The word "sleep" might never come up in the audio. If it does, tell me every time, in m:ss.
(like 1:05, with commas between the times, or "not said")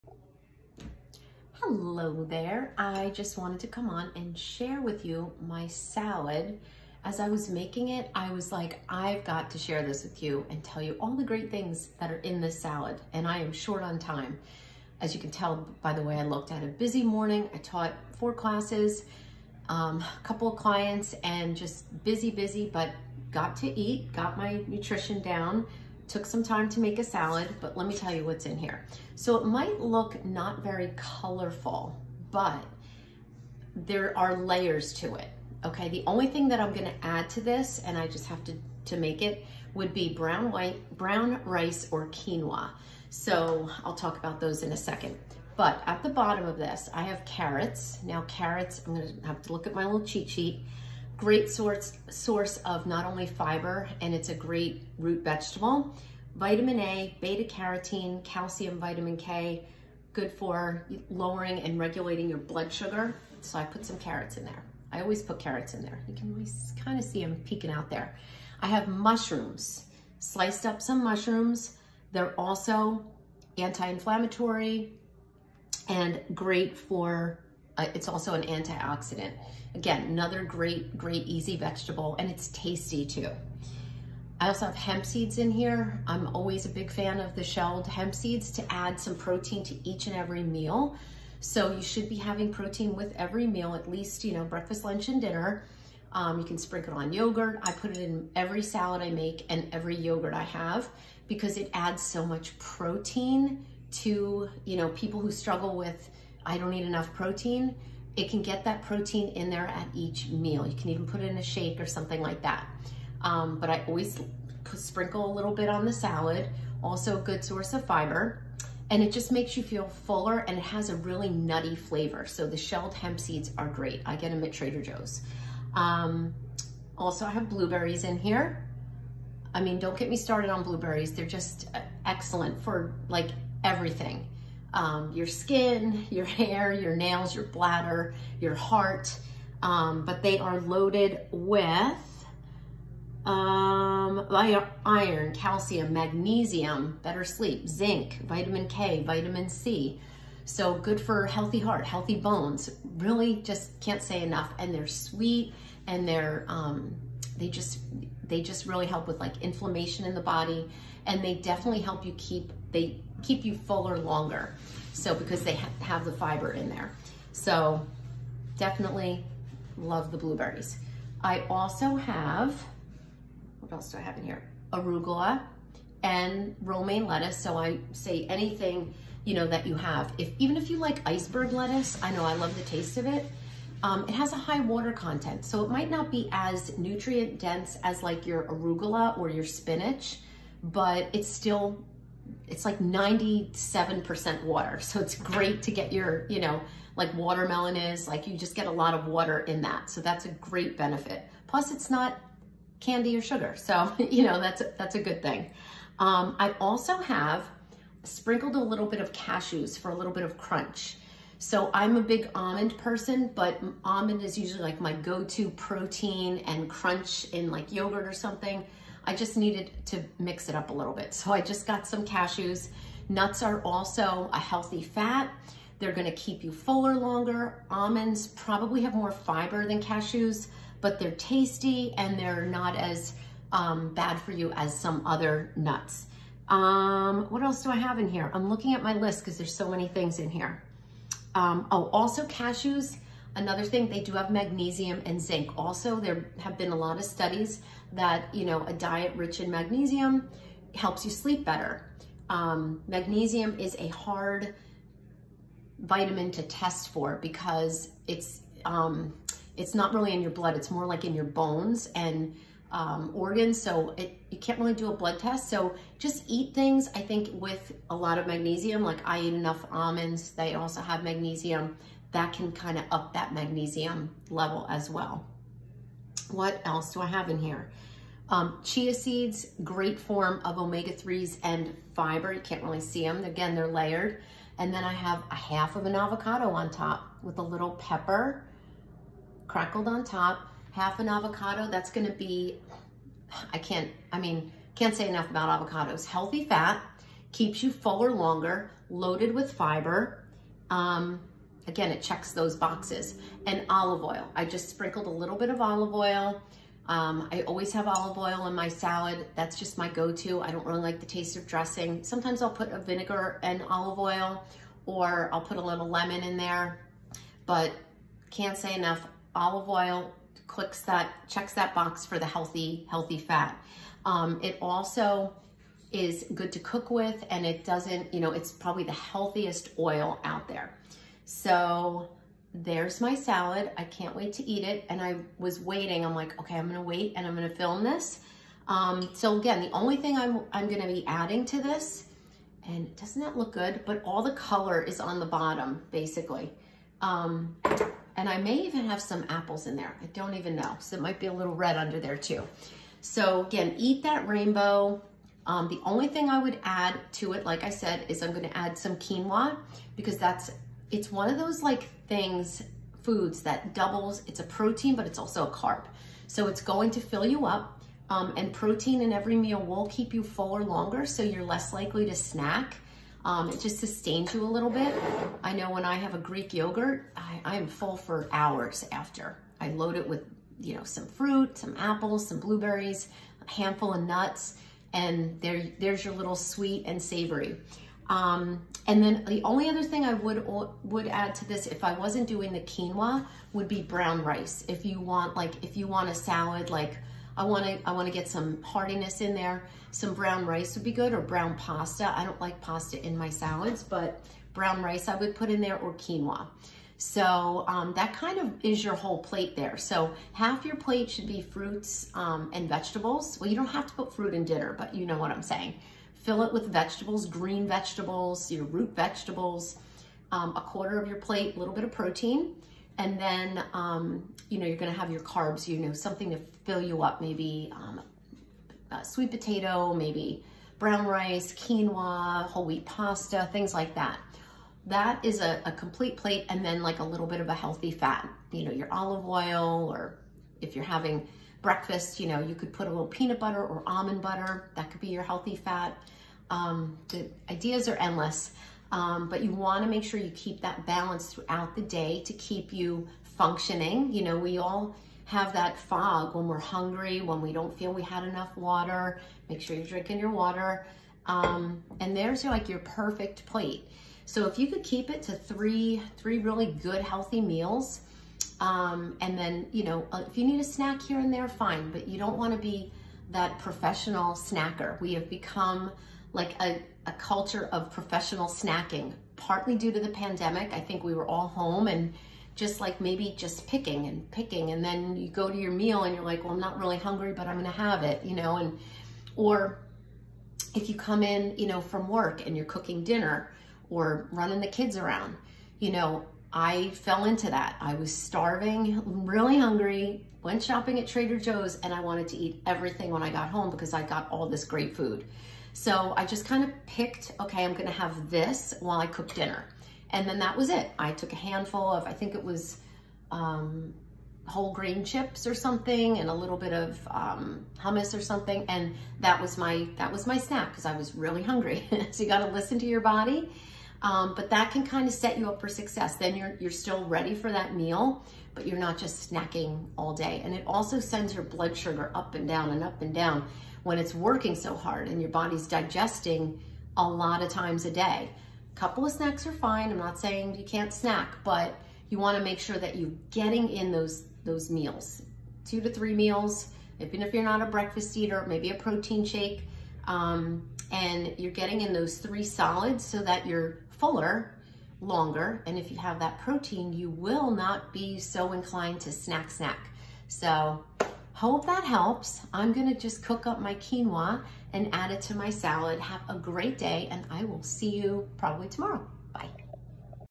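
2:27, 4:11.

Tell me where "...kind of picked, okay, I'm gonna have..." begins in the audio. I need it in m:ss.
8:26.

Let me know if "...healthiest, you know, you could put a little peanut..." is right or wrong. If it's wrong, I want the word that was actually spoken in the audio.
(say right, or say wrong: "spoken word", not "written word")
wrong: "breakfast", not "healthiest".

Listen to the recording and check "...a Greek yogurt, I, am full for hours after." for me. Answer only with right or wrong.
right.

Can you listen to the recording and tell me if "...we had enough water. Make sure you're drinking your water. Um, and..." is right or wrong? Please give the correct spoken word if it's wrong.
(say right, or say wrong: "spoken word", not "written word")
right.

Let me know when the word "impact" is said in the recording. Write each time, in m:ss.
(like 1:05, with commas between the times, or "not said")
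not said.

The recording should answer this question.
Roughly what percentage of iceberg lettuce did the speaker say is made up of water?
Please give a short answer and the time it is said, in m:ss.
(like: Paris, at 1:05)
97%, at 3:12.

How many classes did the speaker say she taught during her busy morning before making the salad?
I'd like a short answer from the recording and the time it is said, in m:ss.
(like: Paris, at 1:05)
4, at 0:18.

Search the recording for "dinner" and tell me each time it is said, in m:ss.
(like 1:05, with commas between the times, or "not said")
1:35, 6:54, 8:13, 8:29.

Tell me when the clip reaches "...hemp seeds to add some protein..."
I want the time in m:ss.
1:27.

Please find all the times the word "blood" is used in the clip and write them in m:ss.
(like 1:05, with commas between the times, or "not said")
1:02, 4:20, 4:24, 8:51.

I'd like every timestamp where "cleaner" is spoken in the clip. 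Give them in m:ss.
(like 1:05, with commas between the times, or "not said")
not said.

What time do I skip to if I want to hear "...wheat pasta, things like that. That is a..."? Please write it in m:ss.
7:12.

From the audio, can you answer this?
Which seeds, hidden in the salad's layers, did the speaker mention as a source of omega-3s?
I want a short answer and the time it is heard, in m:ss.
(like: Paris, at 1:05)
Chia seeds, at 4:38.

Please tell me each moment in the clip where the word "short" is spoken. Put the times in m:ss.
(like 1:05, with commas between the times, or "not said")
0:13.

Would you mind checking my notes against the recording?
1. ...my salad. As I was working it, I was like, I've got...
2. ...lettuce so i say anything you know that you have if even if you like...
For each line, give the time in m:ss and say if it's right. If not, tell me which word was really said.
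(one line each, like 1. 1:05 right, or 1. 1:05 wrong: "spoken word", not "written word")
1. 0:05 wrong: "making", not "working"
2. 2:57 right.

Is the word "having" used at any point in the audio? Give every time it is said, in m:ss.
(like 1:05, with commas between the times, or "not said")
1:32, 7:20.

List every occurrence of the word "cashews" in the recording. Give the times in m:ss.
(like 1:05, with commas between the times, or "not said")
3:29, 3:42, 3:49, 4:02.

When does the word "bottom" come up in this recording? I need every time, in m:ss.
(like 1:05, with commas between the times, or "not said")
0:46, 5:45.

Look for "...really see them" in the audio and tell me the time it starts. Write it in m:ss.
4:42.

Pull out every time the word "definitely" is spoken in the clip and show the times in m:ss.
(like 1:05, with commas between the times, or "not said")
2:41, 2:48.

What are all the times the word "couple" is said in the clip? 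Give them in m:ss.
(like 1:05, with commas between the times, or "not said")
0:20, 8:58.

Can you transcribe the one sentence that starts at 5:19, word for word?
Olive oil, clicks that, checks that box for the healthy, healthy fat.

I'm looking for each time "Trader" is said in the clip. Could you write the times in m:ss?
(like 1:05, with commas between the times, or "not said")
2:04, 8:21.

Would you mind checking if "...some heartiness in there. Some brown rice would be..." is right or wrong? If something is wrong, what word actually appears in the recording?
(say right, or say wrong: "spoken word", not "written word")
right.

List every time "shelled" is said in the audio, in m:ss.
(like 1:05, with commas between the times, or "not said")
1:27, 2:02.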